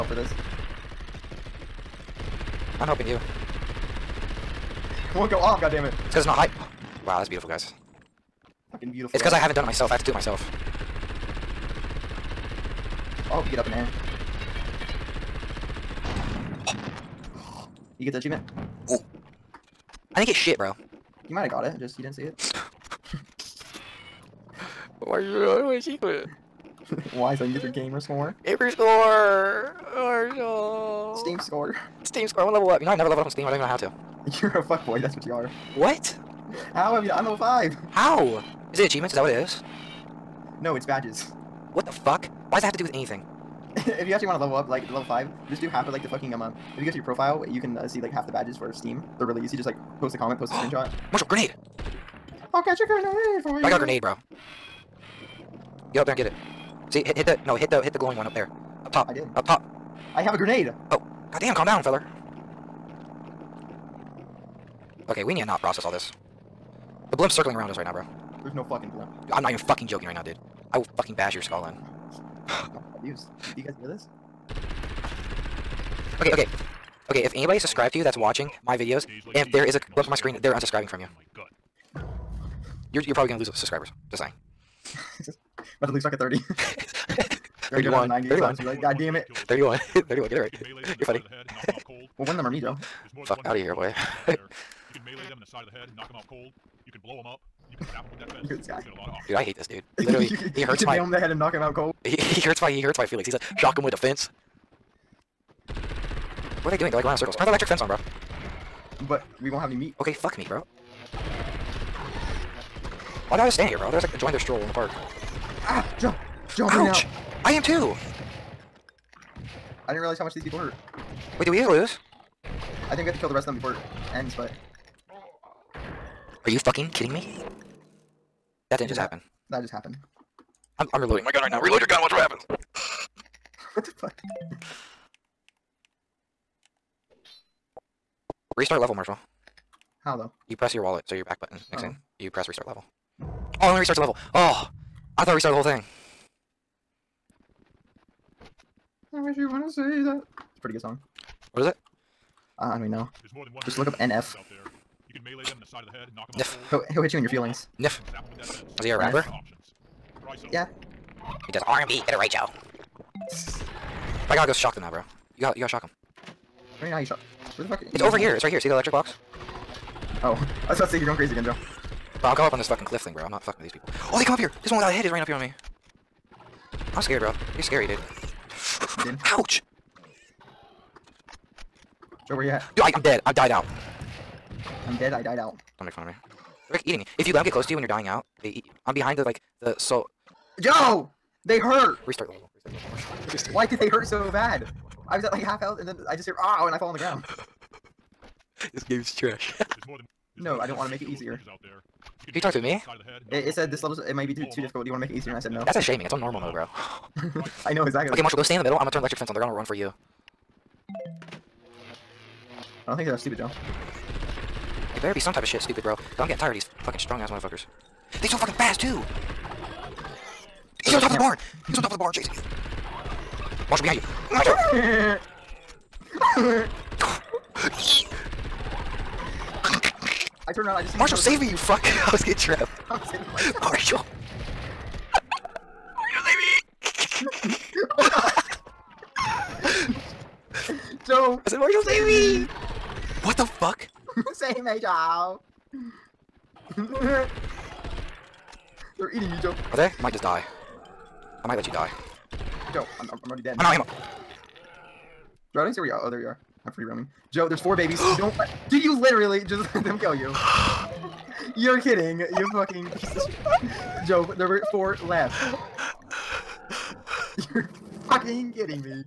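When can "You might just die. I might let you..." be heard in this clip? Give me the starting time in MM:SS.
04:09.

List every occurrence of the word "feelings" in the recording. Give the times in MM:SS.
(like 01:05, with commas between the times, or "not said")
01:43, 02:37.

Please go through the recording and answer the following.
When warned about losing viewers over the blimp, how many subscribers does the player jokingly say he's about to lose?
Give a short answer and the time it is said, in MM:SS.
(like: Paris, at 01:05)
30, at 01:25.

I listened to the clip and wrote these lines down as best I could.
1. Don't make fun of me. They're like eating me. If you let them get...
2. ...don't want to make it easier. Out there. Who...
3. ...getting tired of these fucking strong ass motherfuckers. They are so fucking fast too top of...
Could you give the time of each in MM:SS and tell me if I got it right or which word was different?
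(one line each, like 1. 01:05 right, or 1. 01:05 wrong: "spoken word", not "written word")
1. 03:05 right
2. 03:20 right
3. 03:36 right.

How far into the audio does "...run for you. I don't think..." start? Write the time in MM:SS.
03:29.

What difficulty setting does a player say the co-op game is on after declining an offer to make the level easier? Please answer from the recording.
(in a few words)
normal mode.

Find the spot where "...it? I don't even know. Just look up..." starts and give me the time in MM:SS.
02:31.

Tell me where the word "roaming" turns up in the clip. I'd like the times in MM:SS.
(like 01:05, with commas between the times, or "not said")
04:16.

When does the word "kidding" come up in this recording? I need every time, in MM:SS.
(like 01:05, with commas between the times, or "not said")
02:06, 04:21, 04:28.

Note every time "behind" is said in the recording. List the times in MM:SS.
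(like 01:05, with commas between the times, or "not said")
03:08, 03:43.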